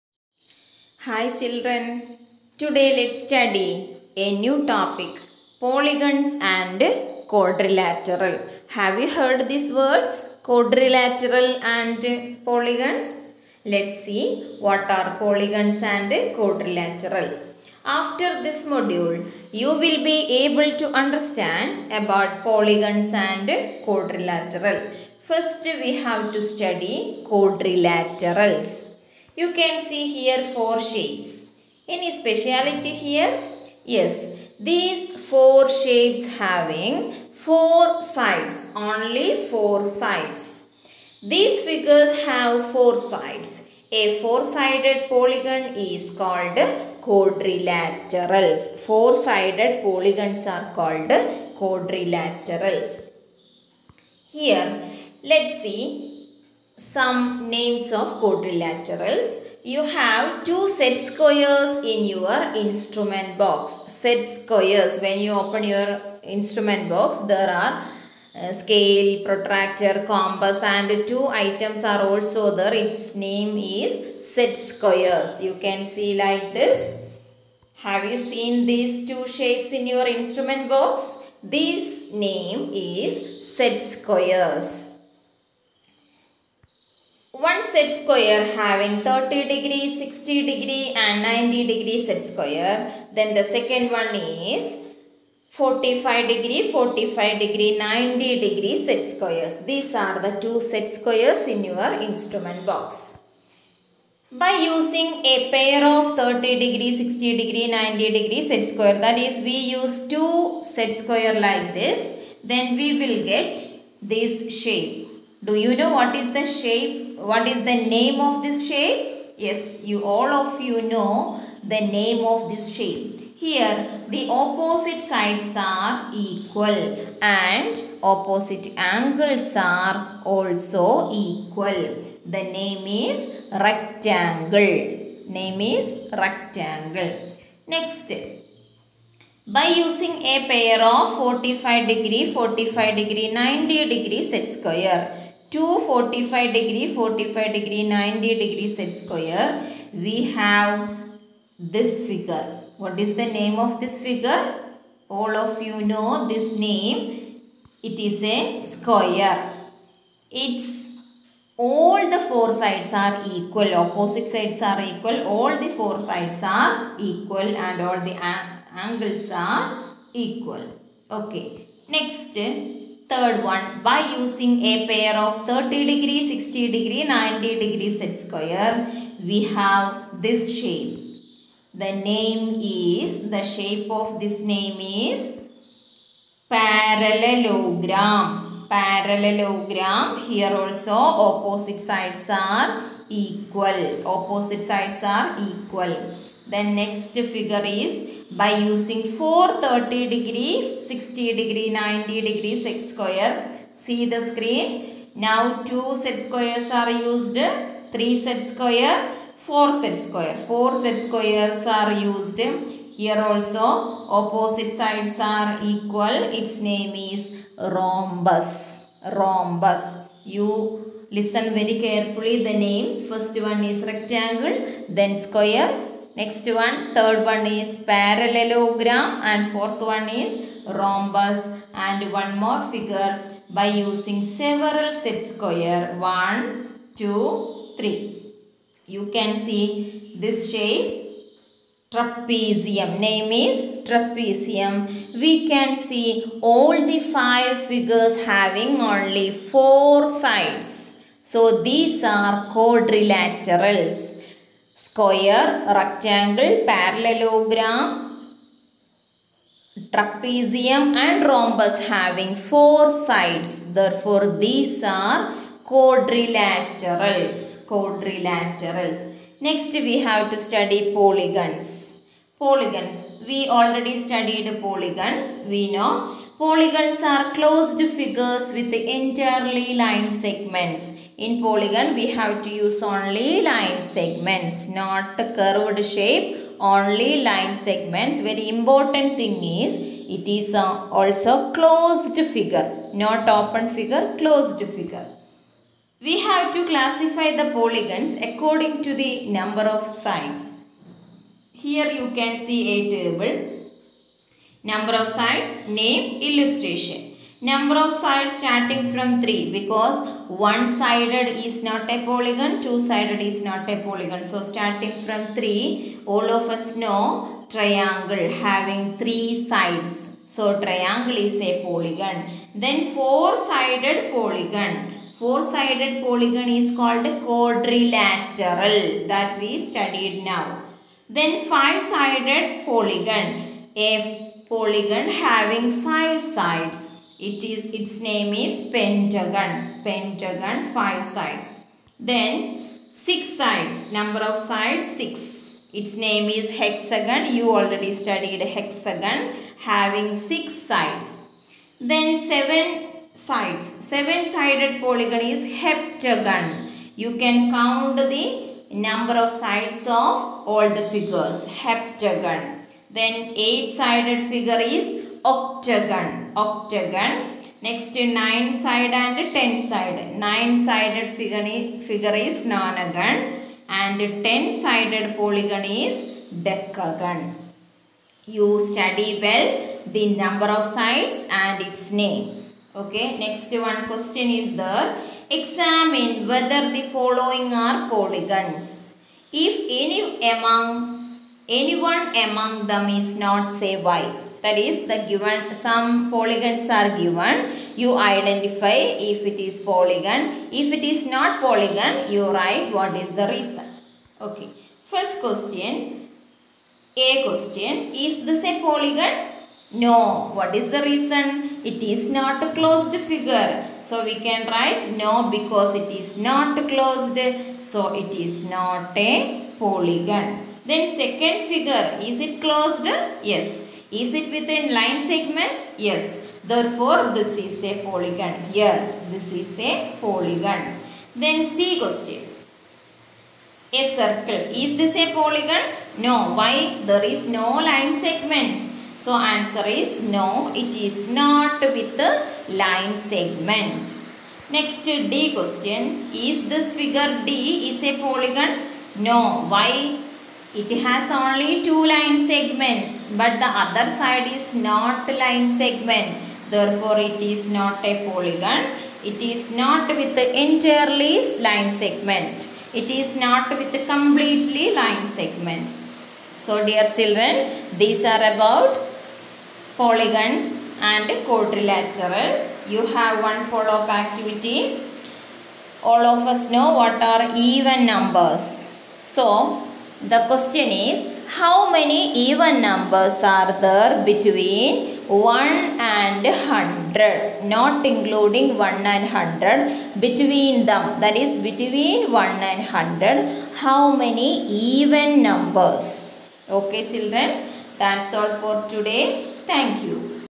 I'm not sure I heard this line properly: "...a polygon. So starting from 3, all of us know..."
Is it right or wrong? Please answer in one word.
right.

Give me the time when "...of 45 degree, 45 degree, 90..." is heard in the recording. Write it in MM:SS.
02:20.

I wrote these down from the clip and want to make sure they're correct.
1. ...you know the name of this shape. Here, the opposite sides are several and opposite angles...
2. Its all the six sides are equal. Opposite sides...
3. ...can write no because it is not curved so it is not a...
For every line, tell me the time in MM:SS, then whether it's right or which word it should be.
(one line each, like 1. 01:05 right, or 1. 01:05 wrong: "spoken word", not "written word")
1. 02:00 wrong: "equal", not "several"
2. 02:40 wrong: "four", not "six"
3. 06:54 wrong: "closed", not "curved".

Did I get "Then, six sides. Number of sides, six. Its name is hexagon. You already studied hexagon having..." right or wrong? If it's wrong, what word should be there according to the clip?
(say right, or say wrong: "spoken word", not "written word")
right.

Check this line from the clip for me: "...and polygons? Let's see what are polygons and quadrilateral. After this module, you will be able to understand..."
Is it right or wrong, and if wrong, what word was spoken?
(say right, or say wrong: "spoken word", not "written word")
right.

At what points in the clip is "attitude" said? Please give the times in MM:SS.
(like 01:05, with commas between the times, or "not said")
not said.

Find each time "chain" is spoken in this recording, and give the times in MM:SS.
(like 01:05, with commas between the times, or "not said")
not said.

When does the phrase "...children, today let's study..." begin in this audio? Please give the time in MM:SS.
00:01.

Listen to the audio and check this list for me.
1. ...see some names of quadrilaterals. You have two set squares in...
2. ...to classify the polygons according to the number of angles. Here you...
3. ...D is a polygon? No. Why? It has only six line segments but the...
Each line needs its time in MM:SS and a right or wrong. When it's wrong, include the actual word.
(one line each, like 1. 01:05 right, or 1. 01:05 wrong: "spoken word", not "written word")
1. 00:55 right
2. 04:56 wrong: "sides", not "angles"
3. 07:27 wrong: "two", not "six".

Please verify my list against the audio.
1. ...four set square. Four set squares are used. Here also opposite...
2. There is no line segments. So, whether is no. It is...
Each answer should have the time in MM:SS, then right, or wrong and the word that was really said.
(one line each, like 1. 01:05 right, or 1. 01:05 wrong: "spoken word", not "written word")
1. 03:29 right
2. 07:16 wrong: "answer", not "whether".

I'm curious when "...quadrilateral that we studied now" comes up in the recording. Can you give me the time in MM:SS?
05:27.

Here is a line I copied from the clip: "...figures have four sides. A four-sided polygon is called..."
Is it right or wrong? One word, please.
right.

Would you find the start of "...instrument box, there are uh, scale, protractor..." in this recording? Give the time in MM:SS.
01:06.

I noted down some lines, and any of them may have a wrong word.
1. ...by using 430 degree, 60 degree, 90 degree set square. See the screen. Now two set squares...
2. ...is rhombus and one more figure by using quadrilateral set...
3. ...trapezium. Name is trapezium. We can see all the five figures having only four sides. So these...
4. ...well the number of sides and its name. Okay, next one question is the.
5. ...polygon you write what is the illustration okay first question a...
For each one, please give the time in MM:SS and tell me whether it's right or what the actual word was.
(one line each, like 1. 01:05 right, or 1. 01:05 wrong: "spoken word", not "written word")
1. 03:18 right
2. 03:50 wrong: "several", not "quadrilateral"
3. 04:01 right
4. 06:19 right
5. 06:41 wrong: "reason", not "illustration".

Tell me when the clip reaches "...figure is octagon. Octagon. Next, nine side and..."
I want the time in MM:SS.
06:04.